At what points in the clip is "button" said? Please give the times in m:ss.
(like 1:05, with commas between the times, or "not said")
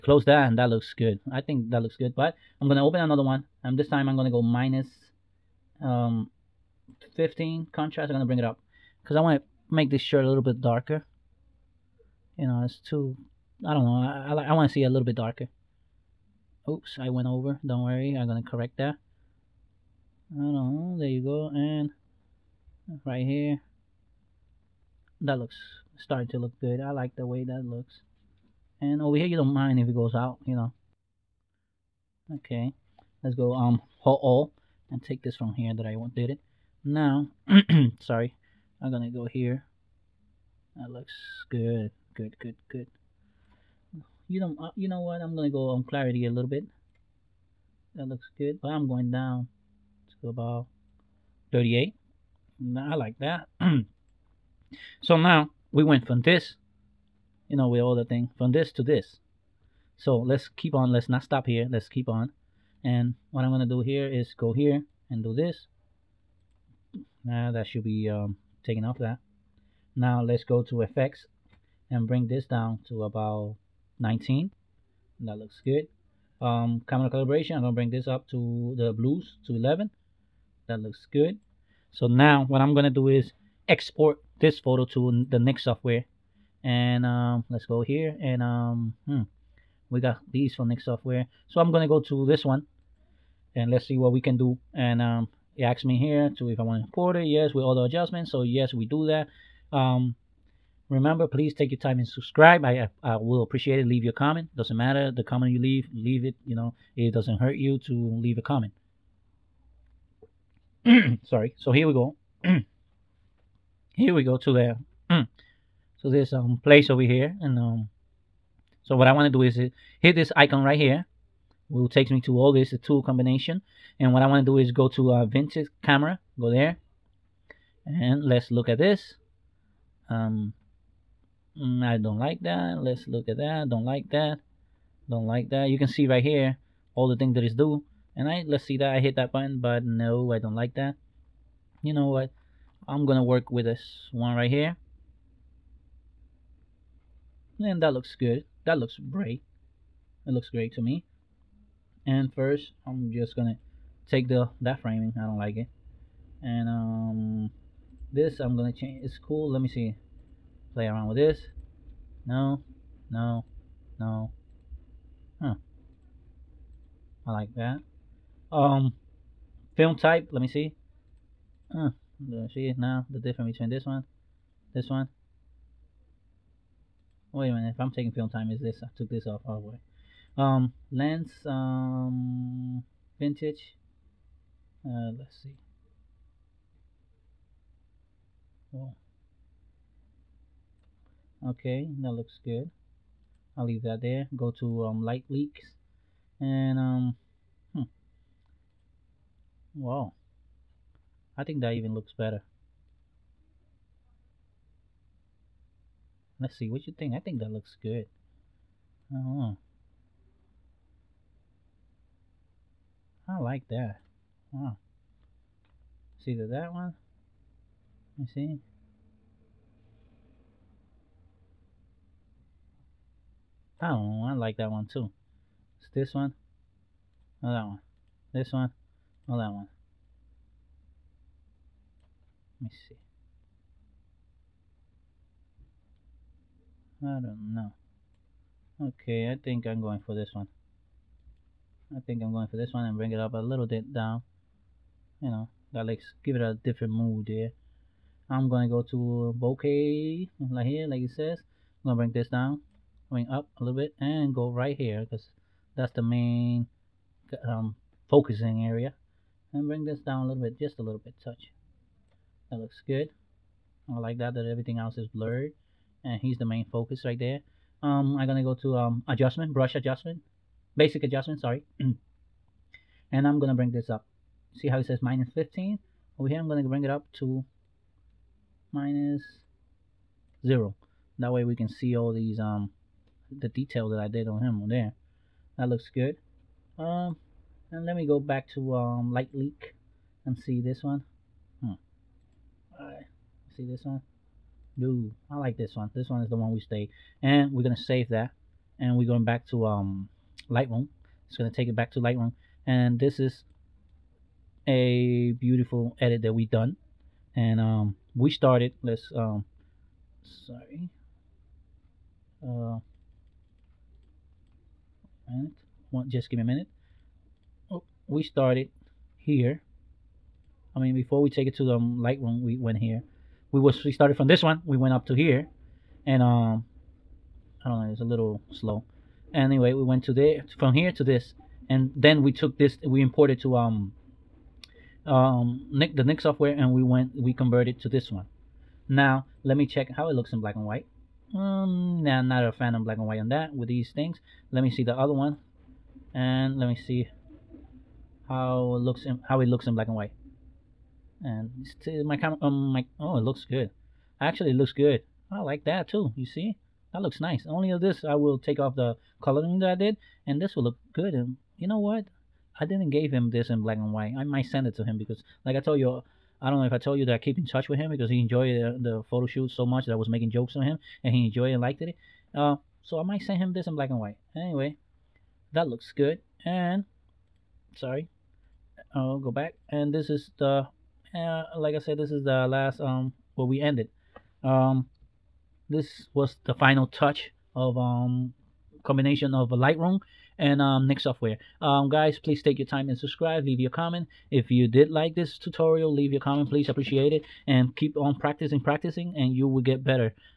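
2:19.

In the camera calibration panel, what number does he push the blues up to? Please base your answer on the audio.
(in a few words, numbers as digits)
11.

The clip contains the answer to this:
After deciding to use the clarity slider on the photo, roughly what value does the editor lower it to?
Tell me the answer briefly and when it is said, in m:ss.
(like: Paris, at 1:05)
38, at 0:51.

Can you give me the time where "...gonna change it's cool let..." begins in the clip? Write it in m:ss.
2:38.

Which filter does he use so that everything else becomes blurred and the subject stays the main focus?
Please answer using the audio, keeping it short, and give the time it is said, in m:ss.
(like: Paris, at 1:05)
bokeh, at 4:09.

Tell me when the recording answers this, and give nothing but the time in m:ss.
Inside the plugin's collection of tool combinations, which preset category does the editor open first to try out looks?
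2:05.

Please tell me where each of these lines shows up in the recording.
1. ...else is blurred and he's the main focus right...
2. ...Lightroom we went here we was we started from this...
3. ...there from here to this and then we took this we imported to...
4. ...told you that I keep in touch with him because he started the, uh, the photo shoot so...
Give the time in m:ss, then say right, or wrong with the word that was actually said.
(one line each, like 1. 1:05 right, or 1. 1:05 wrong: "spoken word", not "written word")
1. 4:24 right
2. 5:21 right
3. 5:30 right
4. 6:06 wrong: "enjoyed", not "started".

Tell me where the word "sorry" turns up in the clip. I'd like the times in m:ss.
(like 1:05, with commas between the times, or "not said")
0:37, 1:51, 4:31, 5:10, 6:17.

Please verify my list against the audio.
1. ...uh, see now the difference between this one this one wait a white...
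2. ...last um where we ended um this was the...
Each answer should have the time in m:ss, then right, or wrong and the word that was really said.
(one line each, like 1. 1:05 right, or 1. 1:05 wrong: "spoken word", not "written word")
1. 2:51 wrong: "minute", not "white"
2. 6:22 right.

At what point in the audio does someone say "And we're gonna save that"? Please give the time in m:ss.
4:57.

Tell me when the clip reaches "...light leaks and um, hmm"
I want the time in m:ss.
3:15.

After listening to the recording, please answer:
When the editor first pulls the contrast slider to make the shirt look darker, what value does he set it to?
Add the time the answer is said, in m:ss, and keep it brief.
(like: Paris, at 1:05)
-15, at 0:04.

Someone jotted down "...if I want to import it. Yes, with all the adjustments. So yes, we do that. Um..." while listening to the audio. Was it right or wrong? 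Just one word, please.
right.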